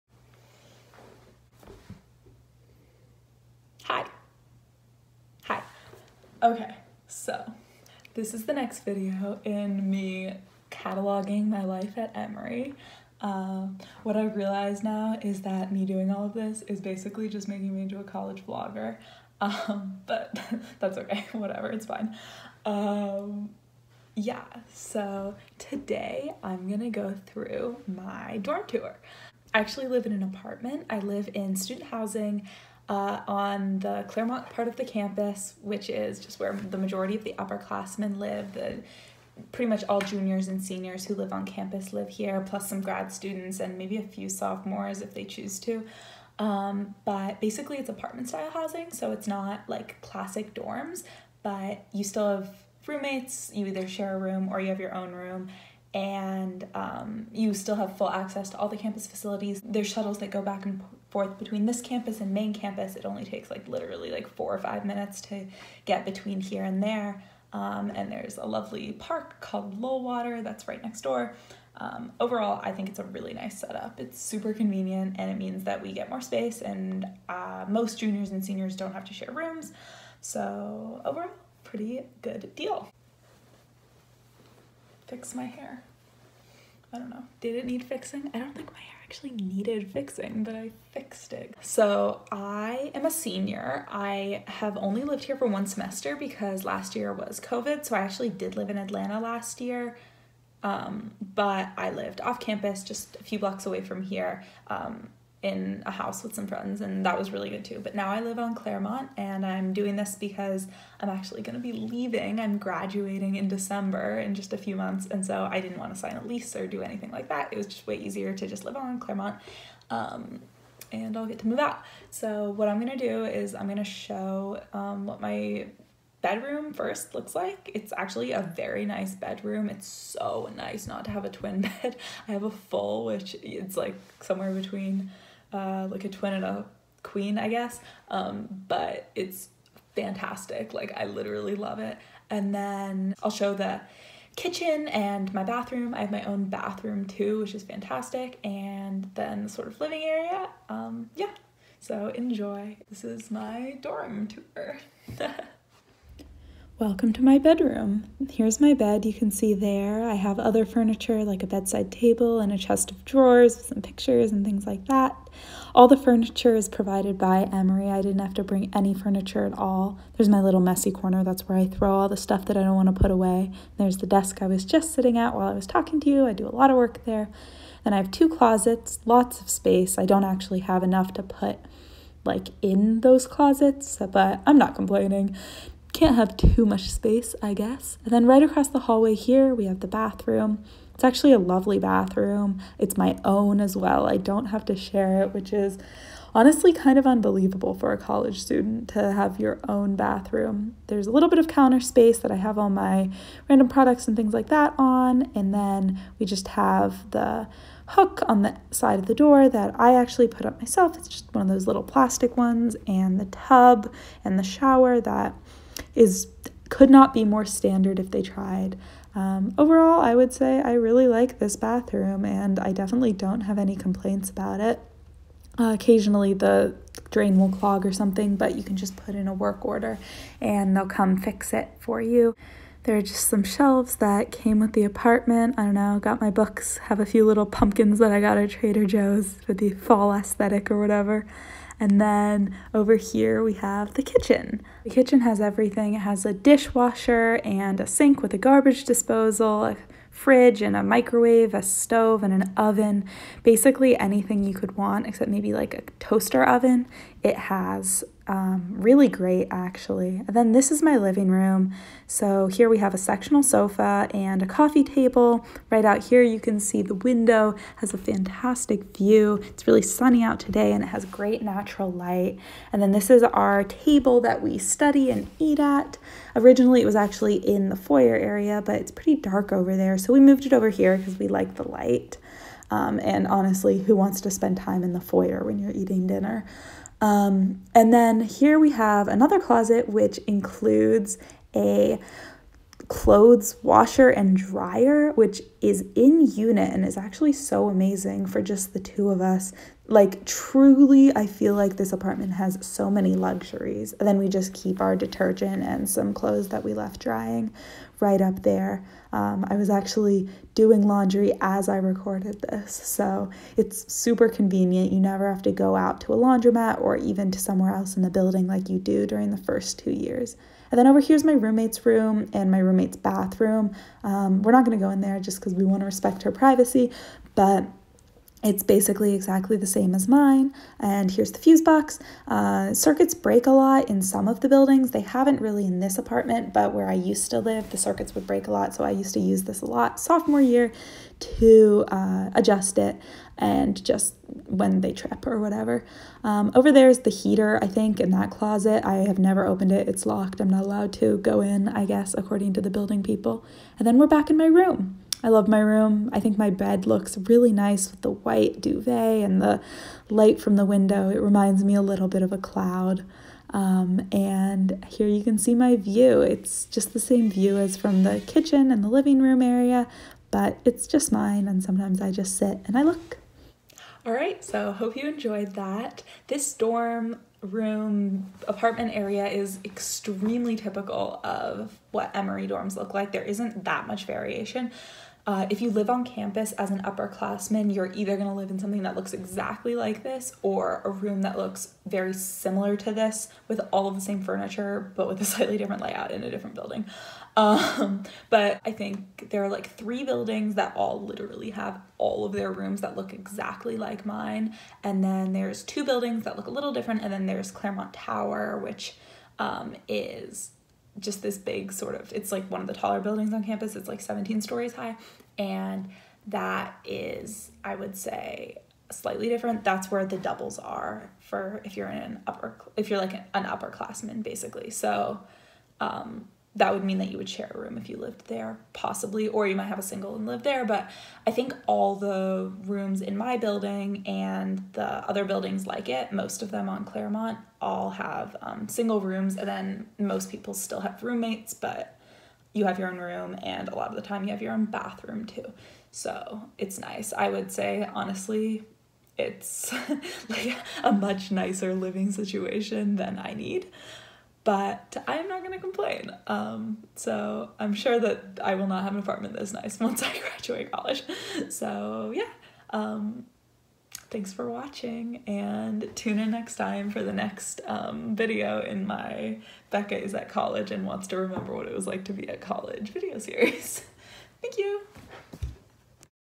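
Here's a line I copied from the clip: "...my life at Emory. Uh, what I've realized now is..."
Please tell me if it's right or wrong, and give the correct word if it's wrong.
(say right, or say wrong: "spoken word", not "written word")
right.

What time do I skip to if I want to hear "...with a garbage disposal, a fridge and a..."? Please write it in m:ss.
4:08.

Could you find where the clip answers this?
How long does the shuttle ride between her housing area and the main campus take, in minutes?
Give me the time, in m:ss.
1:04.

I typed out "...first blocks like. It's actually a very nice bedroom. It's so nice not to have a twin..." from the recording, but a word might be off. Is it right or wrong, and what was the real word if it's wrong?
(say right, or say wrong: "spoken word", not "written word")
wrong: "looks", not "blocks".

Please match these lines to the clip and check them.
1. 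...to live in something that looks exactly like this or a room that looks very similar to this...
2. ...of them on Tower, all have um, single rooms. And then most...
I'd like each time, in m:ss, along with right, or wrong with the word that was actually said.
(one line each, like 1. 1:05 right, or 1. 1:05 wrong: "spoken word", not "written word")
1. 6:28 right
2. 7:16 wrong: "Clairmont", not "Tower".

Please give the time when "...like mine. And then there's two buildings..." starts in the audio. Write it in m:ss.
6:43.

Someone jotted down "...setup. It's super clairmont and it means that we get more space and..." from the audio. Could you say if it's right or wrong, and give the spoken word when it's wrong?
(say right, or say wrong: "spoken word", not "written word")
wrong: "convenient", not "clairmont".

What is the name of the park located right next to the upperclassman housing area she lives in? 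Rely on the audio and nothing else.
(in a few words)
Lullwater.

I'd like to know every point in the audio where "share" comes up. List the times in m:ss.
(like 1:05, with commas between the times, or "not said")
0:53, 1:19, 3:14, 7:07.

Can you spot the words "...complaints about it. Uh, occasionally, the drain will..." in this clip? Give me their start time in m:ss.
3:43.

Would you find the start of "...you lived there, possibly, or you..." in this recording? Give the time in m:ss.
7:07.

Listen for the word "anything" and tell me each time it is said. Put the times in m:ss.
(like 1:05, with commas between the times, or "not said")
1:56, 4:13.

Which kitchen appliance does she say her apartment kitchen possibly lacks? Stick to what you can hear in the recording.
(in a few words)
Toaster oven.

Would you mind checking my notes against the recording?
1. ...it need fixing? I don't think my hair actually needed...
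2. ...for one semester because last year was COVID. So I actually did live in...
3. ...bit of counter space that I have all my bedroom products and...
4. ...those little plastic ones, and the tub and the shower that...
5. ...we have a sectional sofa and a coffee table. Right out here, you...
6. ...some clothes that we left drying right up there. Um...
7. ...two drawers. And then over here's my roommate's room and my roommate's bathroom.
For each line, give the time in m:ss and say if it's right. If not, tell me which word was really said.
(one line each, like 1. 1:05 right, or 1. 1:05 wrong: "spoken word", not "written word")
1. 1:27 right
2. 1:35 right
3. 3:21 wrong: "random", not "bedroom"
4. 3:31 right
5. 4:22 right
6. 5:05 right
7. 5:19 wrong: "years", not "drawers".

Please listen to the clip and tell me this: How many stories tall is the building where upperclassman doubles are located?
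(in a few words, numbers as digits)
17.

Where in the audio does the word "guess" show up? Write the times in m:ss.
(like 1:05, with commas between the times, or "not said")
2:17, 3:07, 5:51.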